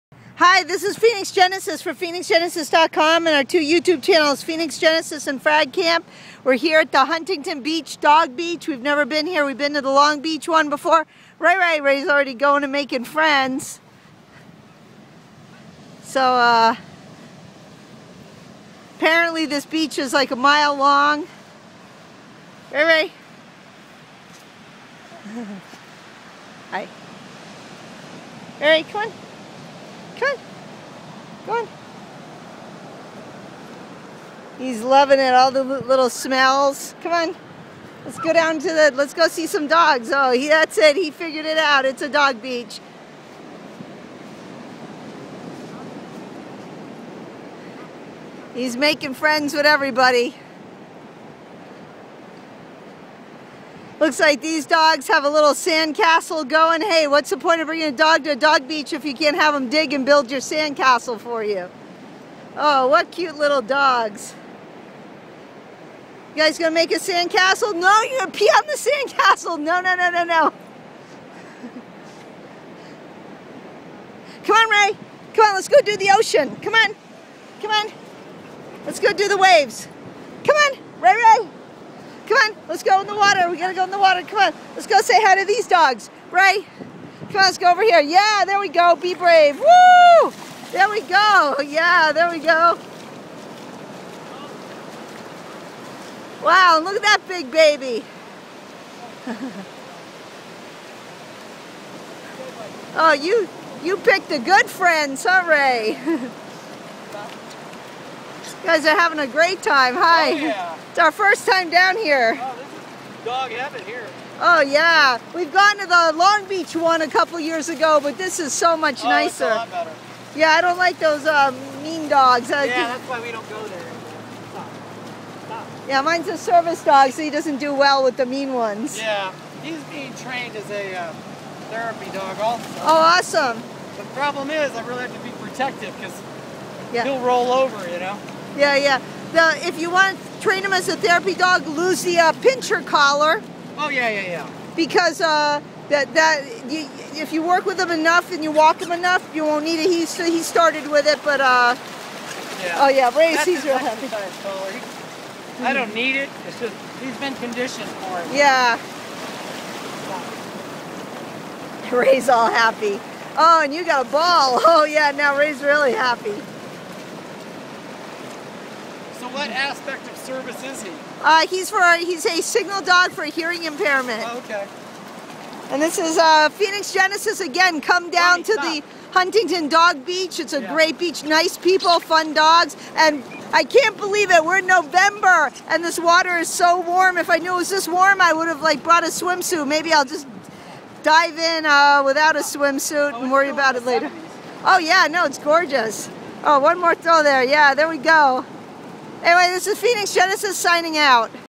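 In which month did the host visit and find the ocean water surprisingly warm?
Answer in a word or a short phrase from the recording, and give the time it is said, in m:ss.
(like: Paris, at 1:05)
November, at 3:04.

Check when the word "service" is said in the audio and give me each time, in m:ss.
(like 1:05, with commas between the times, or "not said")
2:06, 2:50.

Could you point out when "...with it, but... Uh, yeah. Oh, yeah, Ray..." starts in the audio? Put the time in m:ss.
2:30.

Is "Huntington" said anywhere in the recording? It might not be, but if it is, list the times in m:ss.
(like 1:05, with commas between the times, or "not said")
0:07, 2:59.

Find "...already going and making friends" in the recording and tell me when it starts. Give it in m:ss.
0:12.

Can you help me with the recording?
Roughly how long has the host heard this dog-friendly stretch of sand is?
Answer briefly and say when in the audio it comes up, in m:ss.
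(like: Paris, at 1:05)
A mile, at 0:20.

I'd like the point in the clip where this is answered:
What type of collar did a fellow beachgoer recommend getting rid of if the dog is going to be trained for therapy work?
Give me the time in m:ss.
2:22.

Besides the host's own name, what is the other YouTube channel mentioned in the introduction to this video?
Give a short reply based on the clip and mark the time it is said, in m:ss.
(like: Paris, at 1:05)
Frag Camp, at 0:05.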